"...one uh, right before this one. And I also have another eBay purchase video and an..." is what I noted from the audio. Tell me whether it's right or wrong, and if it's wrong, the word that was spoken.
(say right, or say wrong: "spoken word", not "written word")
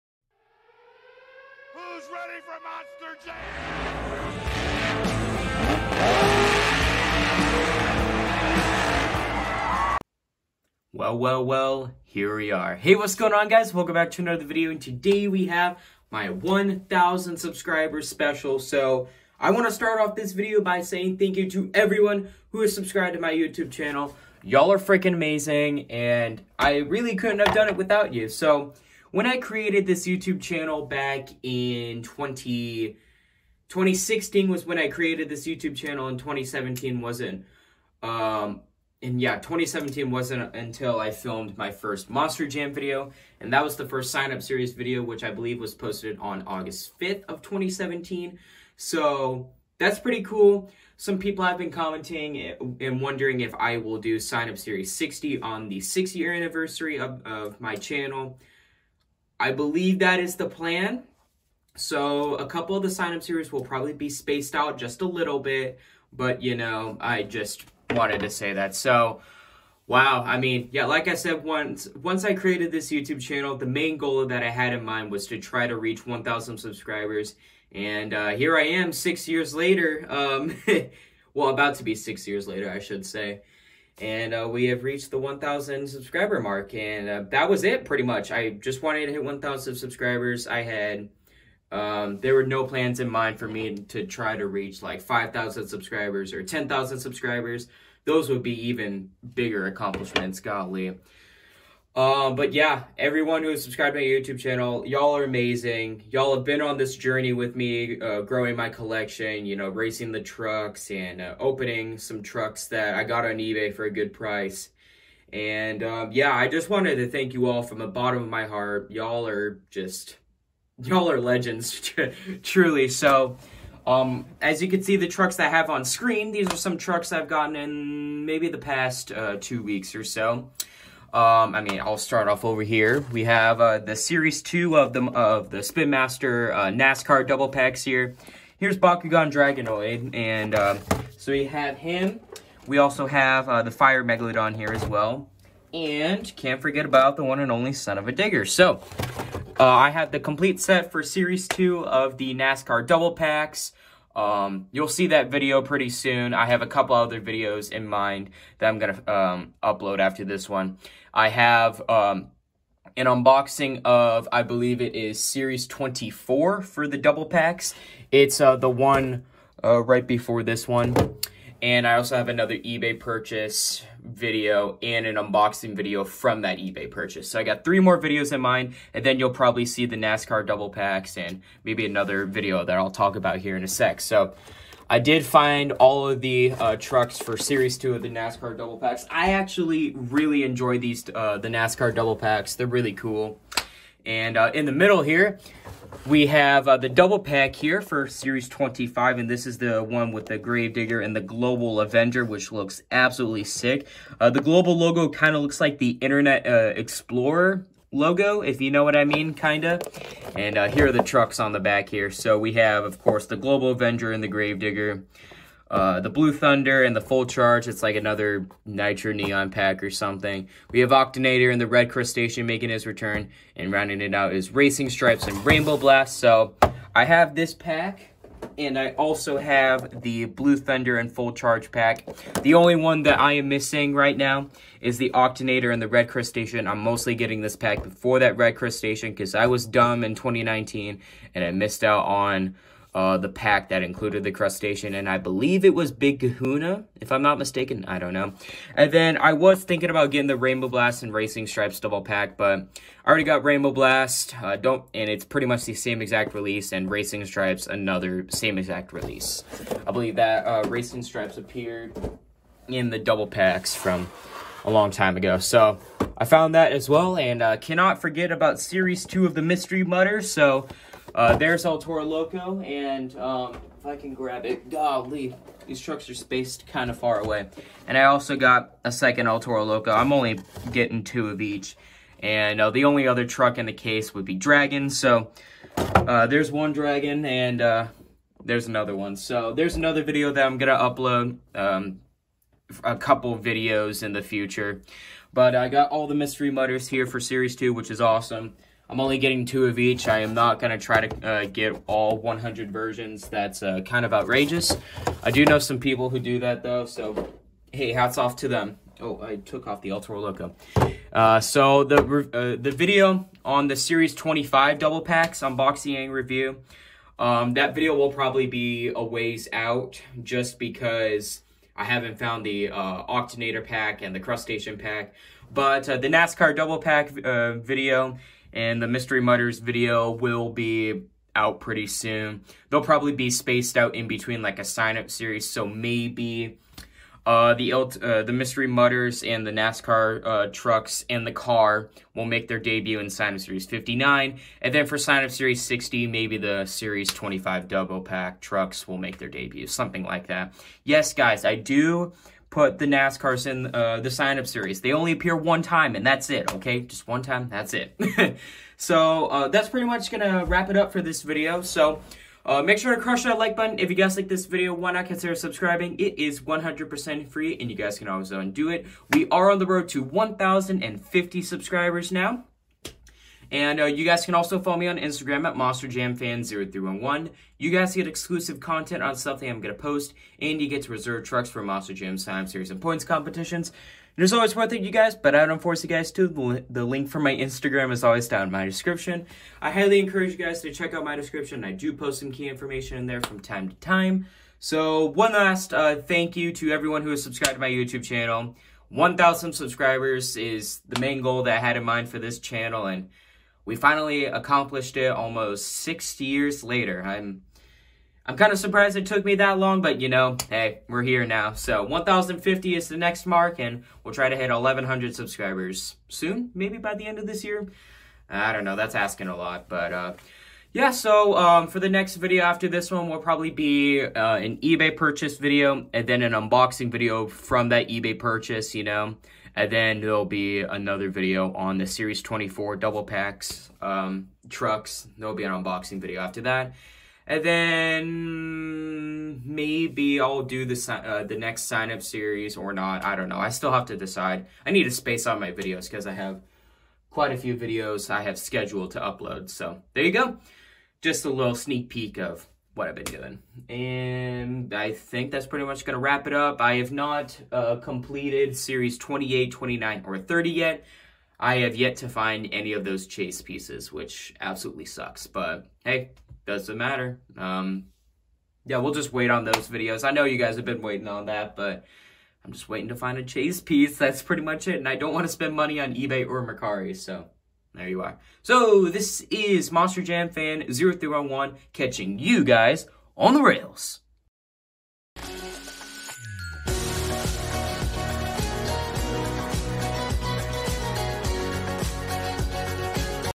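right.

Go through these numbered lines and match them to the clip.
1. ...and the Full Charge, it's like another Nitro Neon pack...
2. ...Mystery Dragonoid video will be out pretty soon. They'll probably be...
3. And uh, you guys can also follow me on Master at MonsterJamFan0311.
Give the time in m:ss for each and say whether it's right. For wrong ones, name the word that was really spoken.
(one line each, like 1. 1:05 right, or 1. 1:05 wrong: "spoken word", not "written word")
1. 3:36 right
2. 5:28 wrong: "Mudders", not "Dragonoid"
3. 6:13 wrong: "Instagram", not "Master".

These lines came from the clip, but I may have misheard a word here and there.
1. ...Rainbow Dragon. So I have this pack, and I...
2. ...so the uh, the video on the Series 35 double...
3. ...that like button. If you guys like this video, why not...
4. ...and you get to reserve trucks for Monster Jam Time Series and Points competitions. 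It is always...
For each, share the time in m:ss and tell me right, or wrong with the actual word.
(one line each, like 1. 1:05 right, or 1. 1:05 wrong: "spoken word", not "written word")
1. 3:45 wrong: "Blast", not "Dragon"
2. 5:11 wrong: "25", not "35"
3. 6:03 right
4. 6:20 right.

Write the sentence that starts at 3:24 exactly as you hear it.
Uh, the Global logo kind of looks like the Internet uh, Explorer logo, if you know what I mean, kind of.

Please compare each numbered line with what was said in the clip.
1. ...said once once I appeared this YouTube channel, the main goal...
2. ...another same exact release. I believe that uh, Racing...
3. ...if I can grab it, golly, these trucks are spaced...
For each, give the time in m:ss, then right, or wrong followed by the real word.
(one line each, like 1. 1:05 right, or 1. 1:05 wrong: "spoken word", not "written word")
1. 1:11 wrong: "created", not "appeared"
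2. 4:17 right
3. 4:33 right.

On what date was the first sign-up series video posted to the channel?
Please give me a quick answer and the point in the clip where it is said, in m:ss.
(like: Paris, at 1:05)
August 5th, at 0:46.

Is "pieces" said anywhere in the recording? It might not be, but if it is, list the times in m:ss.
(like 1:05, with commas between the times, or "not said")
7:43, 7:53.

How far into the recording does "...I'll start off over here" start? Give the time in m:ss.
2:11.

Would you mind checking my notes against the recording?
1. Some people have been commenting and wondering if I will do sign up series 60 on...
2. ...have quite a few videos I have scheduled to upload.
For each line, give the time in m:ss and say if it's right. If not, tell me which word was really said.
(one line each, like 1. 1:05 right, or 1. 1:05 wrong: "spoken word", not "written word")
1. 0:50 right
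2. 7:26 right.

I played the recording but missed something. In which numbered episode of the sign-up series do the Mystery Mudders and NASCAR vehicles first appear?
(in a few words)
59.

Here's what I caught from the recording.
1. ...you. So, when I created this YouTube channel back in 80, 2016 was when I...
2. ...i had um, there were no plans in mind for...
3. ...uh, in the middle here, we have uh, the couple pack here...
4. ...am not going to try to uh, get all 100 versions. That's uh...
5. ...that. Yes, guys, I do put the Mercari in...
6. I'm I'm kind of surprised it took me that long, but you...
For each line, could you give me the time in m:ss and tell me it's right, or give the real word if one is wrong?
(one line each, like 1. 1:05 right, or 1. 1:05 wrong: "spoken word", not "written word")
1. 0:28 wrong: "20", not "80"
2. 1:30 right
3. 3:14 wrong: "double", not "couple"
4. 5:00 right
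5. 5:50 wrong: "NASCARs", not "Mercari"
6. 6:47 right.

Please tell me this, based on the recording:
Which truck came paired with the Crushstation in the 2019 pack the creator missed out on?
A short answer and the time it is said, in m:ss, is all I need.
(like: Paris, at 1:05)
Big Kahuna, at 4:05.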